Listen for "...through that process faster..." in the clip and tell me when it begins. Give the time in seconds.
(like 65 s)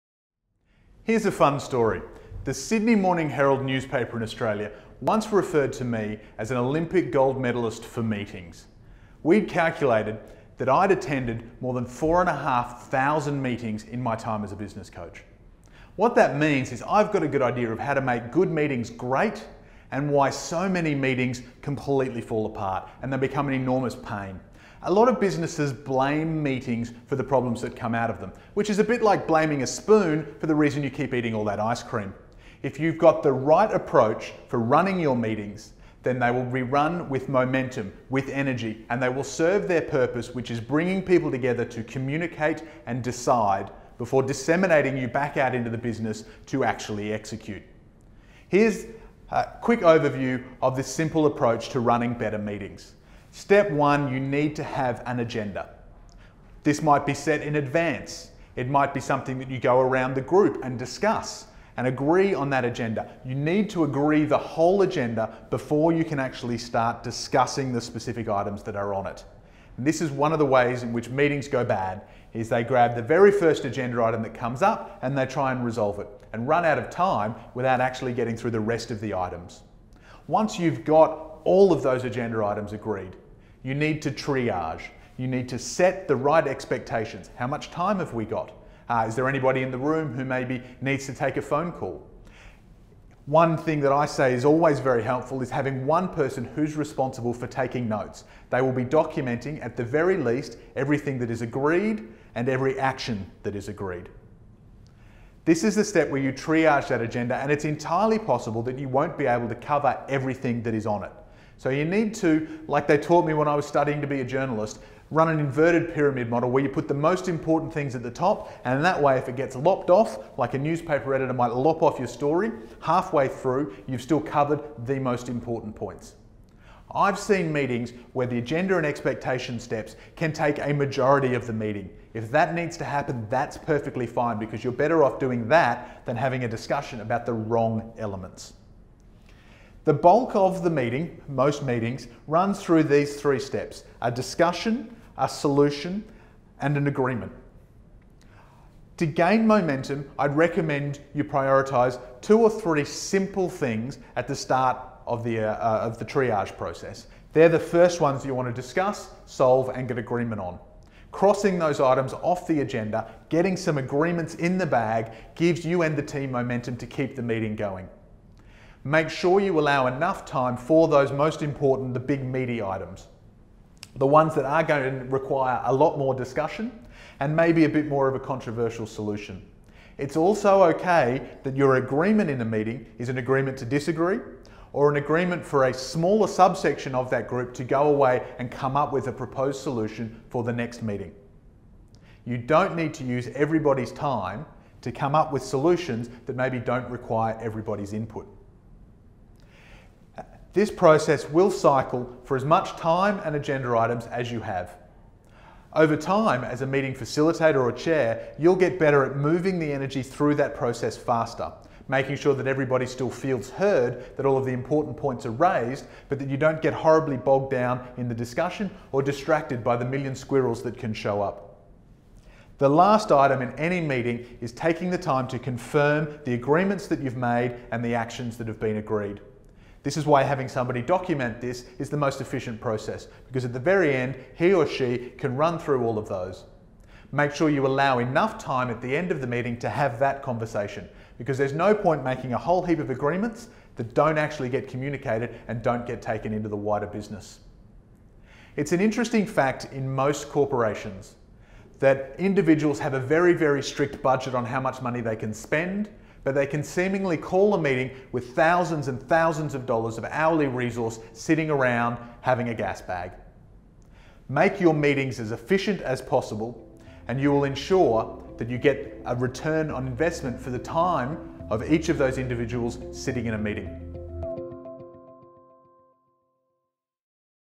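210 s.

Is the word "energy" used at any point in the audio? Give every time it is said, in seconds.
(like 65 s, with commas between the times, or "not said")
38 s, 209 s.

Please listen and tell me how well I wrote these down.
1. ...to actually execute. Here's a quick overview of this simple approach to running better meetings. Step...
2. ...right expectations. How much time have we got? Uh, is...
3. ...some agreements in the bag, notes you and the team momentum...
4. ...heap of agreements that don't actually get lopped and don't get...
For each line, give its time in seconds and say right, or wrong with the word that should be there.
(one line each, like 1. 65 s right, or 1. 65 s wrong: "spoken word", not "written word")
1. 46 s right
2. 86 s right
3. 163 s wrong: "gives", not "notes"
4. 242 s wrong: "communicated", not "lopped".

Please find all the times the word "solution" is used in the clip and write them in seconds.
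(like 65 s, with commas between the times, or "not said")
145 s, 178 s, 189 s, 195 s.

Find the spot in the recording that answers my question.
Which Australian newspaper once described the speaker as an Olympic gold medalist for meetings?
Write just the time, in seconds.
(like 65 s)
2 s.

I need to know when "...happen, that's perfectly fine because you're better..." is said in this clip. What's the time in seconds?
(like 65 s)
132 s.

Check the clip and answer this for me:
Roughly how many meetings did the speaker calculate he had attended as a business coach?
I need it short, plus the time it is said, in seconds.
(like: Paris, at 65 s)
more than 4,500, at 11 s.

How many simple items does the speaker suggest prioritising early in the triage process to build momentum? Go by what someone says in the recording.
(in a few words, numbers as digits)
2 or 3.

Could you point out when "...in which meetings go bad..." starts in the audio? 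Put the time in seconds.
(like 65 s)
70 s.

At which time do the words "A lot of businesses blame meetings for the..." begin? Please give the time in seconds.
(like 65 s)
24 s.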